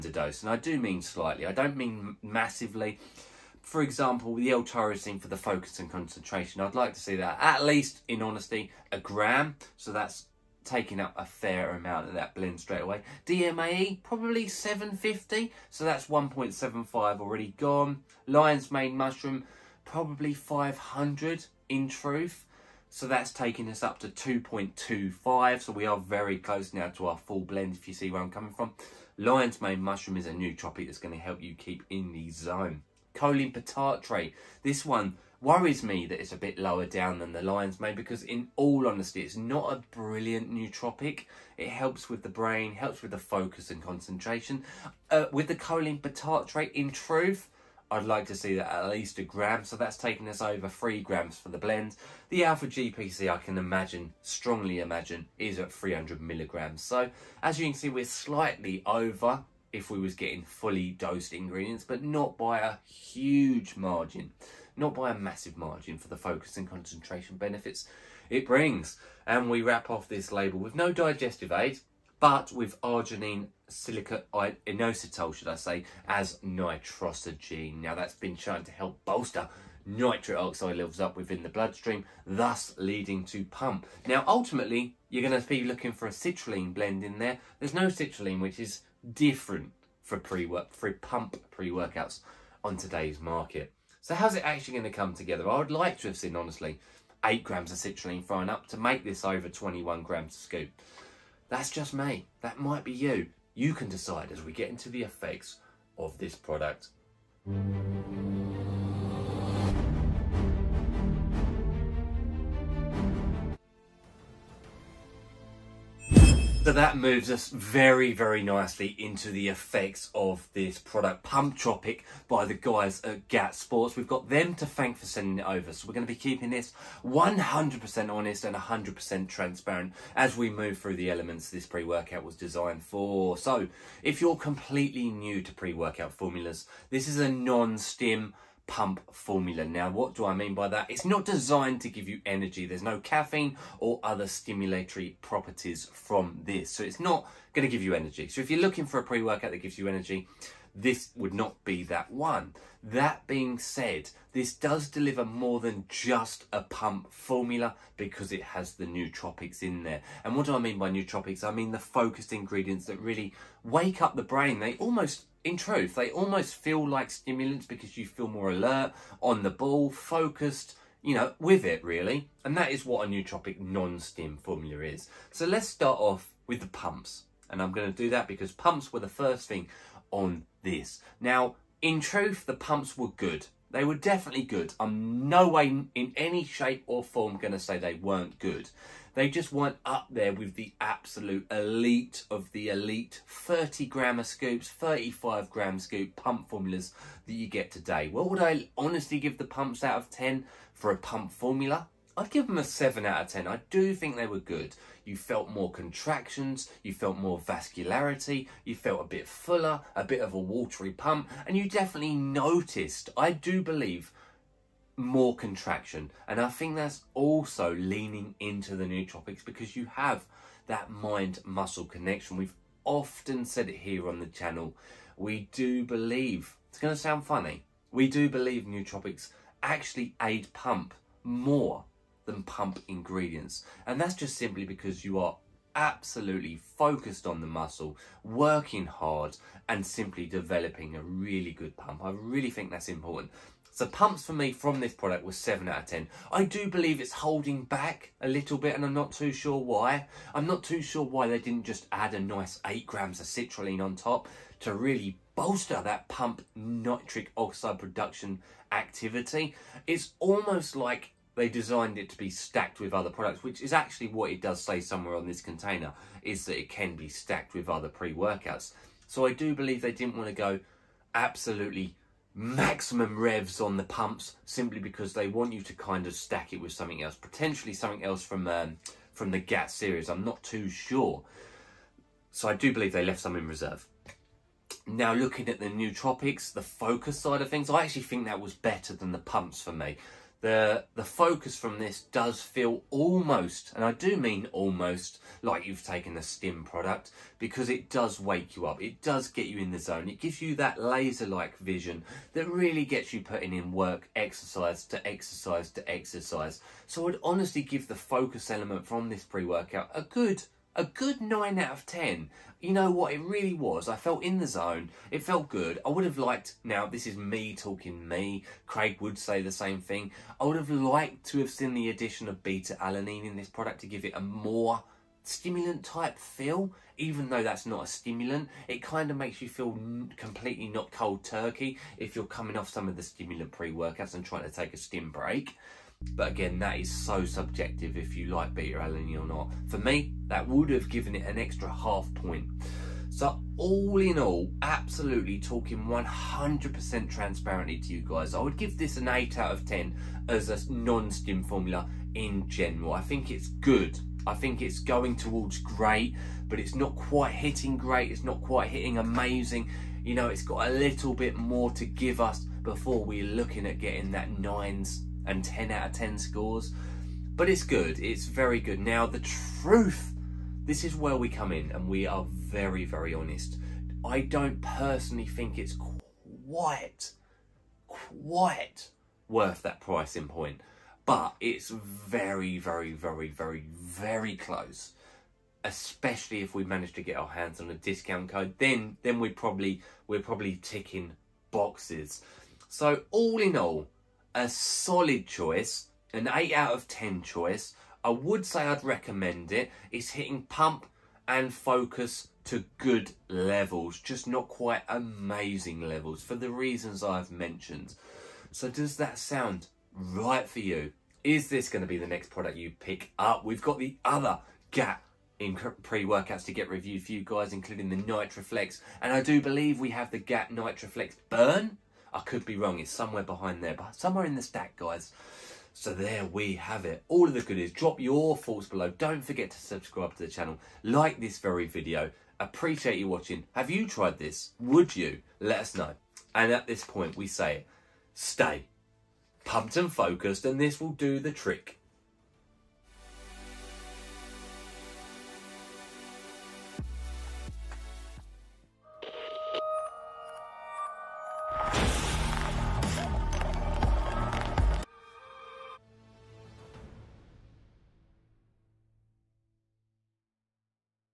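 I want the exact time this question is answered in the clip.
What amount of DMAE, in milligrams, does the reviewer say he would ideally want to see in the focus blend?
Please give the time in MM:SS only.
00:13.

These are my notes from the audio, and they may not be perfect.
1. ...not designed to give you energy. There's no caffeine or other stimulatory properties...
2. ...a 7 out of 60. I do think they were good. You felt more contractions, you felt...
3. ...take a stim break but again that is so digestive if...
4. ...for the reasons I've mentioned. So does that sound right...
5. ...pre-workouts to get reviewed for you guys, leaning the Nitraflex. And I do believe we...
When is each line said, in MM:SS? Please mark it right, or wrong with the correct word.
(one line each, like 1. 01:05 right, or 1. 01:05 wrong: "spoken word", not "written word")
1. 02:21 right
2. 03:22 wrong: "10", not "60"
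3. 05:34 wrong: "subjective", not "digestive"
4. 06:46 right
5. 06:55 wrong: "including", not "leaning".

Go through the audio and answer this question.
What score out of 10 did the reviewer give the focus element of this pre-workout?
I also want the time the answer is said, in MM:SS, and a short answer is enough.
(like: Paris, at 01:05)
9, at 05:10.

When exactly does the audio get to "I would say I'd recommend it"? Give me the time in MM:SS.
06:38.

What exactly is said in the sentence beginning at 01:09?
And we wrap off this label with no digestive aid, but with arginine silicate inositol, should I say, as Nitrosigine.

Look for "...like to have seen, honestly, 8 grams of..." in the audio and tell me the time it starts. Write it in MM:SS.
01:35.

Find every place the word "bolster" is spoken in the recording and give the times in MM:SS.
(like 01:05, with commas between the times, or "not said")
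01:19, 04:15.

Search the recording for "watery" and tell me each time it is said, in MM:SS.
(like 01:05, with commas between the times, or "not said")
03:30.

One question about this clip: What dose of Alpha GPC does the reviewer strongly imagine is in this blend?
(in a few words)
300 milligrams.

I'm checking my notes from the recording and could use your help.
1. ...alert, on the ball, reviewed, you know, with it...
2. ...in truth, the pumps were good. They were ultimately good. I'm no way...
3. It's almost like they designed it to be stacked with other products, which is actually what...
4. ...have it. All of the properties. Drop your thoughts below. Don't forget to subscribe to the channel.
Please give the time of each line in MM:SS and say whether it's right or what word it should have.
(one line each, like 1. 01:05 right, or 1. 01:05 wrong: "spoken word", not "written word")
1. 02:48 wrong: "focused", not "reviewed"
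2. 03:01 wrong: "definitely", not "ultimately"
3. 04:19 right
4. 07:06 wrong: "goodies", not "properties".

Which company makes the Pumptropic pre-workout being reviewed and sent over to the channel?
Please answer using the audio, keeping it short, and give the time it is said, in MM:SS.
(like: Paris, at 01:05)
GAT Sports, at 02:03.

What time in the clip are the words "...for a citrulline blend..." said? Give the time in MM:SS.
01:25.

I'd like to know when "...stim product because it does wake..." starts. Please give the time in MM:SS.
04:56.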